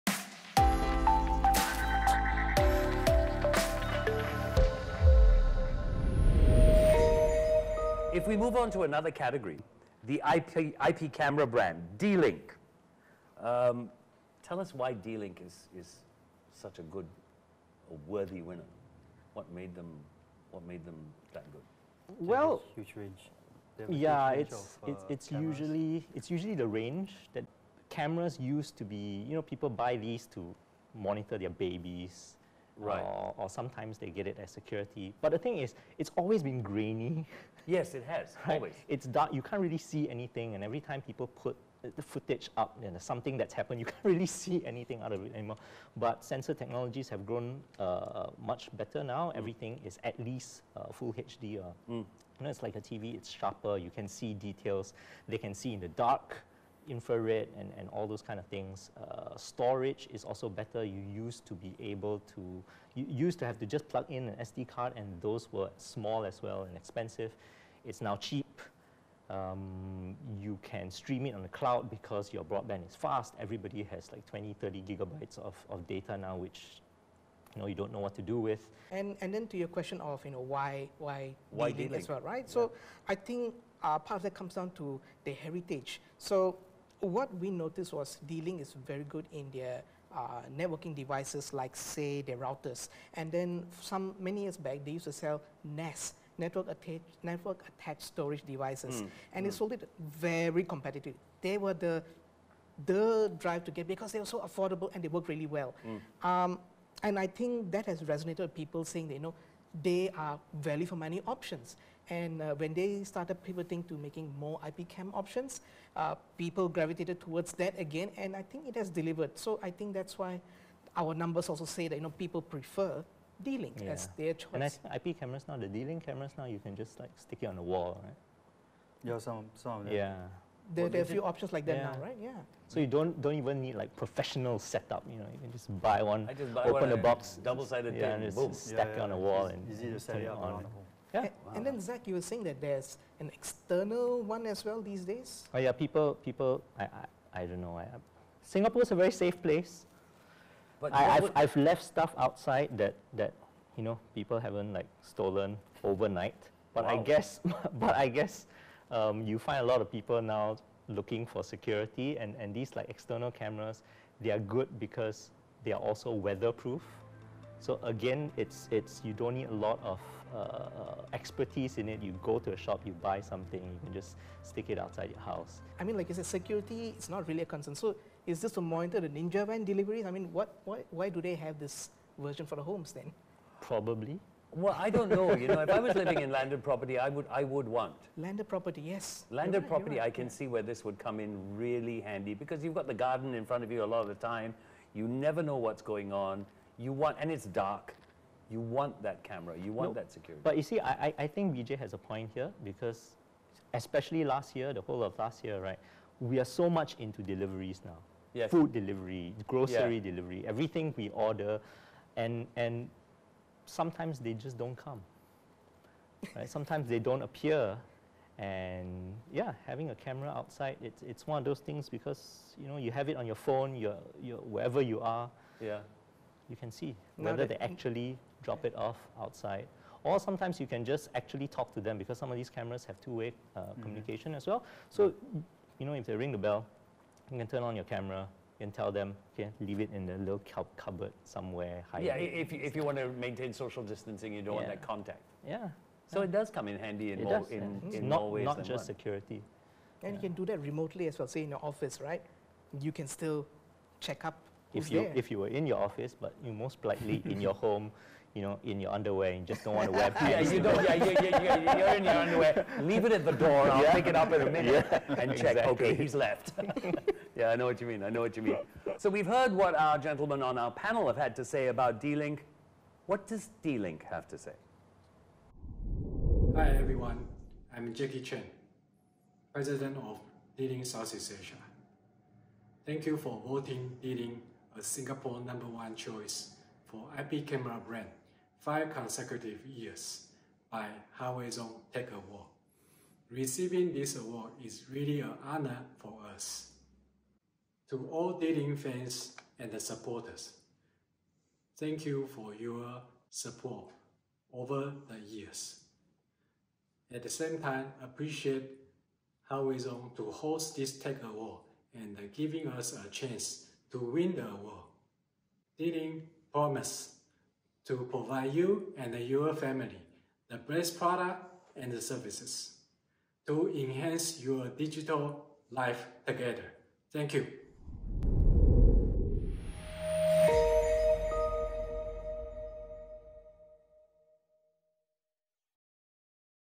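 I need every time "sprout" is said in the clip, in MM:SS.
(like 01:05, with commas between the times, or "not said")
not said.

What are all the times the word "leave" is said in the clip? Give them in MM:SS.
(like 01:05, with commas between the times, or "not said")
03:59, 04:22.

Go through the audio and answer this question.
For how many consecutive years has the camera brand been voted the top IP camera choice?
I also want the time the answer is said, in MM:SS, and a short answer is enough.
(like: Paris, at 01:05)
5, at 04:48.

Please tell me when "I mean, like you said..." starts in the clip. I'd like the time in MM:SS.
02:55.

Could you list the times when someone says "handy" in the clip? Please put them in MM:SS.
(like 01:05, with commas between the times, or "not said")
03:12, 04:06.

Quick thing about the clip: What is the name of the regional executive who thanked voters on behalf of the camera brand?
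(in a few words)
Jackie Chen.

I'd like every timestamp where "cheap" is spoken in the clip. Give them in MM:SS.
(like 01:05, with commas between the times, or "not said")
01:08.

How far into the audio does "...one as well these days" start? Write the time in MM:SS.
02:24.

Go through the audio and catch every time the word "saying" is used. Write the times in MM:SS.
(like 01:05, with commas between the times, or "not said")
01:48, 02:22.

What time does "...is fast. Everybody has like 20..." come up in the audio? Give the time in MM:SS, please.
01:12.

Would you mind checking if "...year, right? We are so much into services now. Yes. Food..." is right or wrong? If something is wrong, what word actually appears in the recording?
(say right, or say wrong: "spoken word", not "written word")
wrong: "deliveries", not "services".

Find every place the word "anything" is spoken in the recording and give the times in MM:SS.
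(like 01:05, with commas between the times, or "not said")
00:40, 00:44.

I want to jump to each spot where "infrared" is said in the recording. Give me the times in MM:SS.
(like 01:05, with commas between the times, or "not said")
00:56.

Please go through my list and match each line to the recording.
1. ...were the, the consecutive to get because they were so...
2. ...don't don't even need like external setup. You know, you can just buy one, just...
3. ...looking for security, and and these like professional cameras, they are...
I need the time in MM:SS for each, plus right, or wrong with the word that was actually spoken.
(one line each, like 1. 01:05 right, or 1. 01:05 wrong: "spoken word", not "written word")
1. 01:41 wrong: "drive", not "consecutive"
2. 02:12 wrong: "professional", not "external"
3. 02:40 wrong: "external", not "professional".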